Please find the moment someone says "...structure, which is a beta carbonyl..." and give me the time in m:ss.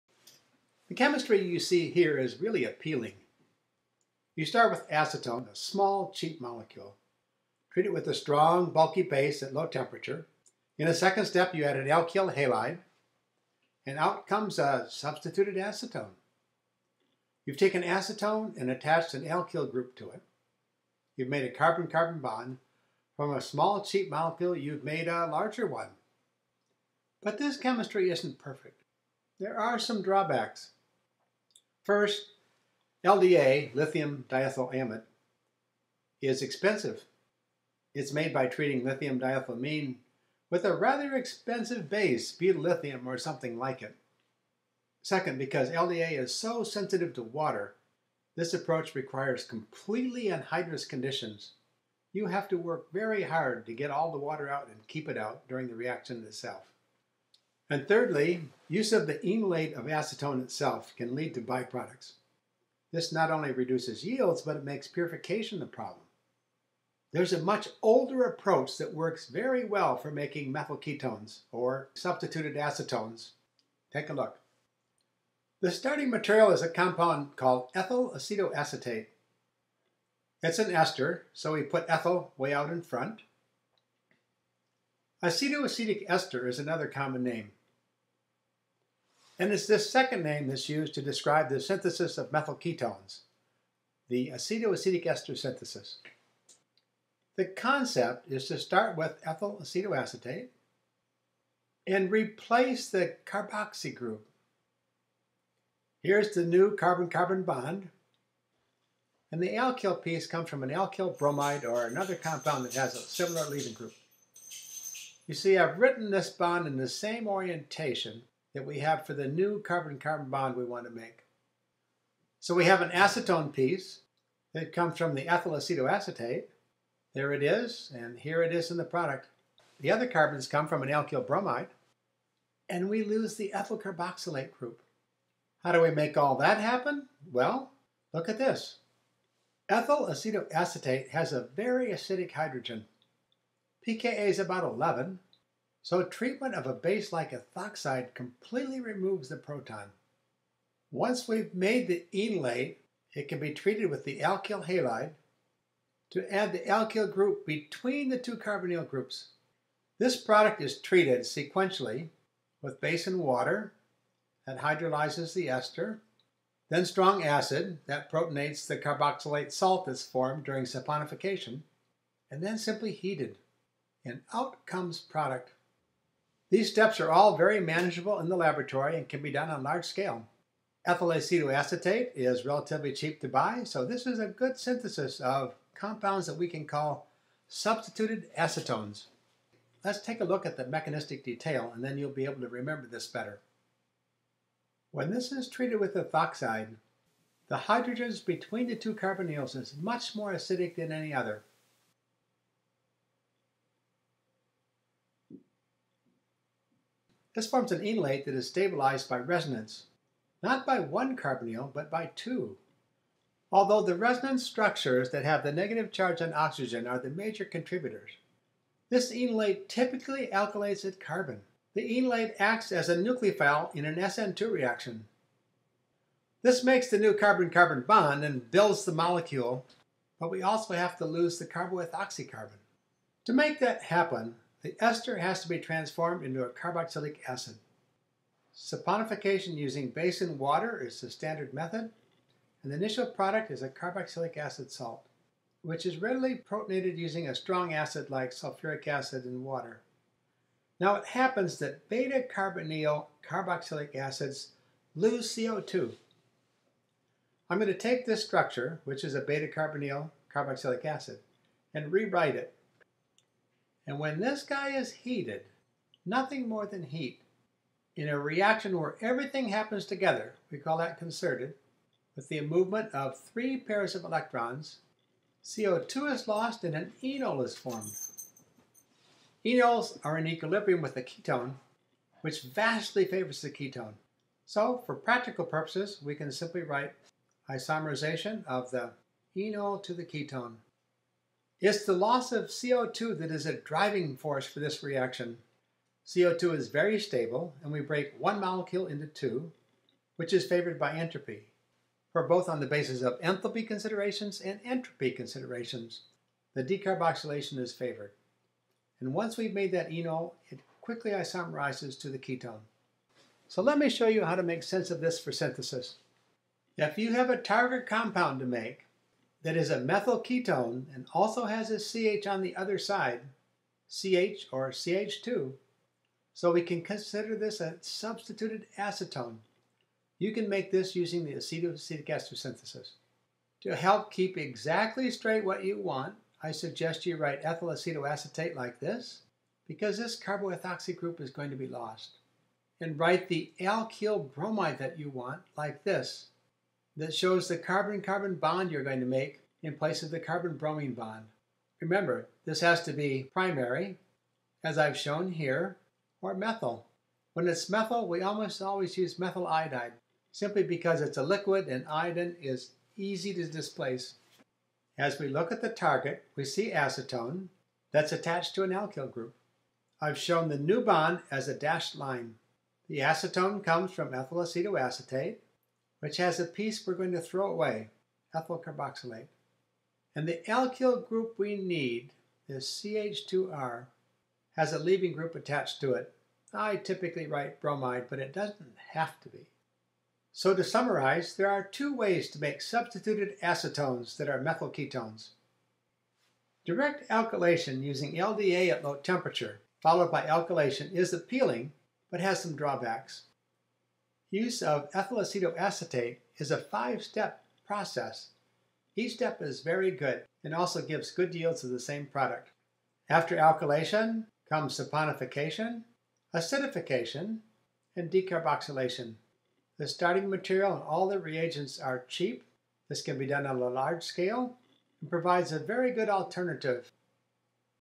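4:18.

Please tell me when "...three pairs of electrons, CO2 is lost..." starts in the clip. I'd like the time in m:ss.
4:33.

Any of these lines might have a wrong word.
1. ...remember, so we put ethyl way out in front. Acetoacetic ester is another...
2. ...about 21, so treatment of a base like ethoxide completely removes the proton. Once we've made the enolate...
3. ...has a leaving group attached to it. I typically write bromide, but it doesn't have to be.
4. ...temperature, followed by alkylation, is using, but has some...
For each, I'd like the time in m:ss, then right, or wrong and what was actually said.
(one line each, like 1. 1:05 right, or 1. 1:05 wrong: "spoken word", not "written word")
1. 1:20 wrong: "ester", not "remember"
2. 2:24 wrong: "11", not "21"
3. 6:24 right
4. 6:38 wrong: "appealing", not "using".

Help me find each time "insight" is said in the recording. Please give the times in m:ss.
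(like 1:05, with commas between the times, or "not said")
not said.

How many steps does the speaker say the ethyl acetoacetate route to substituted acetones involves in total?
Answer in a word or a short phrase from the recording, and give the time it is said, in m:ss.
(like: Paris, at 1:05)
5, at 6:46.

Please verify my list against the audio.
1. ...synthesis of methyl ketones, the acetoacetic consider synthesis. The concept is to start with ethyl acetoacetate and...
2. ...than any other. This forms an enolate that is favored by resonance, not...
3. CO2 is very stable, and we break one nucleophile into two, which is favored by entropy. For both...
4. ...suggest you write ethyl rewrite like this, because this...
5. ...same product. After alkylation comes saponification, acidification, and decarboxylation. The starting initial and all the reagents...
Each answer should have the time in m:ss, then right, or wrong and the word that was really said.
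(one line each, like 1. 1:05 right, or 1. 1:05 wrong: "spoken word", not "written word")
1. 1:31 wrong: "ester", not "consider"
2. 3:20 wrong: "stabilized", not "favored"
3. 4:56 wrong: "molecule", not "nucleophile"
4. 5:36 wrong: "acetoacetate", not "rewrite"
5. 6:51 wrong: "material", not "initial".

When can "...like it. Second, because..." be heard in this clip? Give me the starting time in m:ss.
0:43.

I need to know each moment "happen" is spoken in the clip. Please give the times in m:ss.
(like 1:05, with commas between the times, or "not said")
2:16, 3:53, 4:11, 4:29.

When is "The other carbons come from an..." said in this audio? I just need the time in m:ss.
2:09.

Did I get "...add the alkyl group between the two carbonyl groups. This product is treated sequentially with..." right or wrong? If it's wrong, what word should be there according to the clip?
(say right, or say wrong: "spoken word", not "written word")
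right.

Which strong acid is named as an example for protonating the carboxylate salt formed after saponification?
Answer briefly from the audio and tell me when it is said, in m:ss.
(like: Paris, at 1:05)
sulfuric acid, at 4:08.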